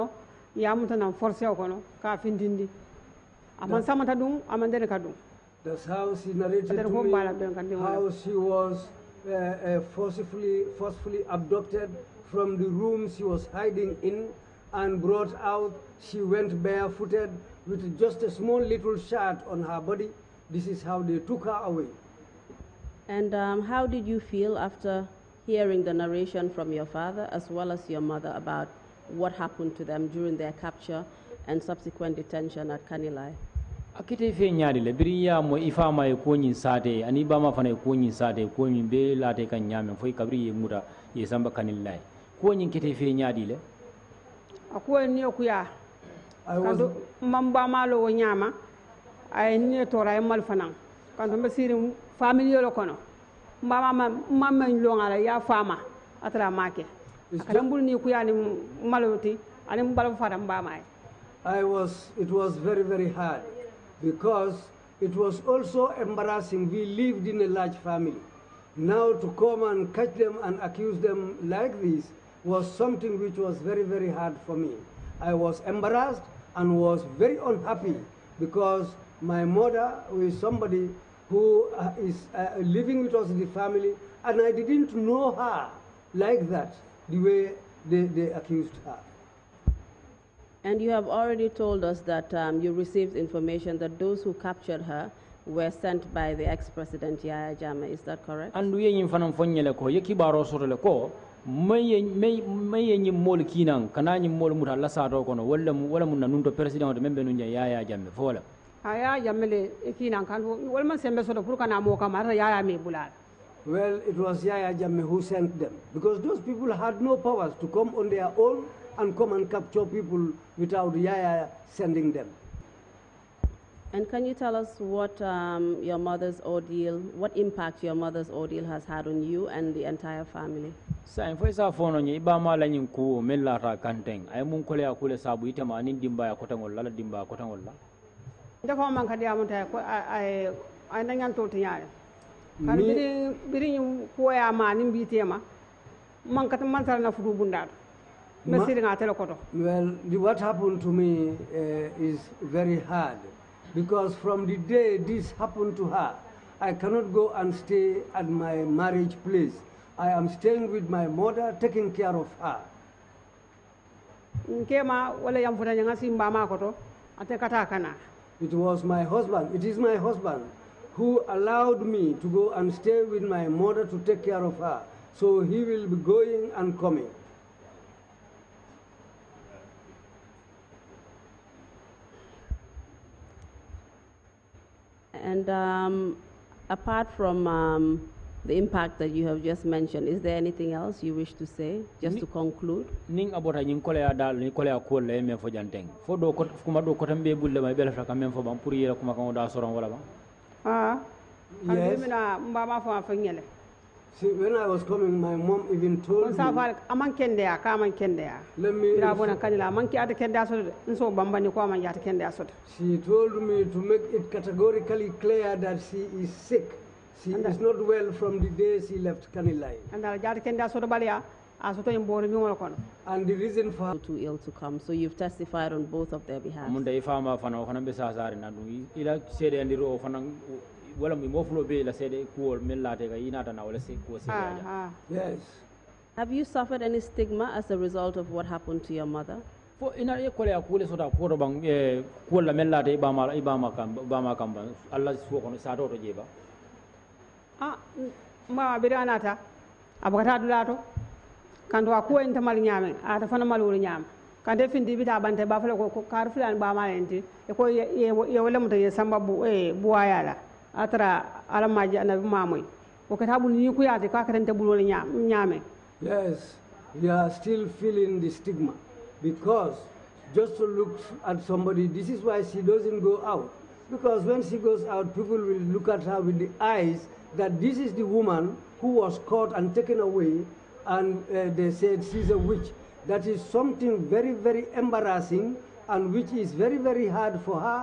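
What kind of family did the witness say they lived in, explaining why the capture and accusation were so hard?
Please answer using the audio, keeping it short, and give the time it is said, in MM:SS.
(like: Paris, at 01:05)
large family, at 01:07.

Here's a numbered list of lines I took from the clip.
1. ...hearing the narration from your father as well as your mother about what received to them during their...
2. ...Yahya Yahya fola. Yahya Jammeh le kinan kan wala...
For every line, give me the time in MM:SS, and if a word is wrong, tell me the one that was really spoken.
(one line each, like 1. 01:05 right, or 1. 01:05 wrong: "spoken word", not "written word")
1. 00:25 wrong: "happened", not "received"
2. 01:47 wrong: "Jammeh", not "Yahya".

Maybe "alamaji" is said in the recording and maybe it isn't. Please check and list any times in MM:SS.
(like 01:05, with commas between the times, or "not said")
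04:21.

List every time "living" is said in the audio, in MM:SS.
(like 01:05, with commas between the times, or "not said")
01:22.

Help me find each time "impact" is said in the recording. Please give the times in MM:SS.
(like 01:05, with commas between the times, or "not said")
02:07, 03:08.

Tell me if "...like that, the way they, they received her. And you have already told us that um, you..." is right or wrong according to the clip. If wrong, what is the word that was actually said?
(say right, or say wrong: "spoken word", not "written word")
wrong: "accused", not "received".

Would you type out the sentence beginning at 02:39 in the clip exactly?
I am staying with my mother, taking care of her.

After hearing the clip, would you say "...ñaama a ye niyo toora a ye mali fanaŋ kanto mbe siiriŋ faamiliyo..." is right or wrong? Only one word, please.
right.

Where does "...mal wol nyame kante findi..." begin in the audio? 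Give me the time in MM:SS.
04:13.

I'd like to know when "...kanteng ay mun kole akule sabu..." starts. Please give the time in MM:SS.
02:13.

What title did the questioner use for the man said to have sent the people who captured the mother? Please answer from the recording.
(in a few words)
ex-president.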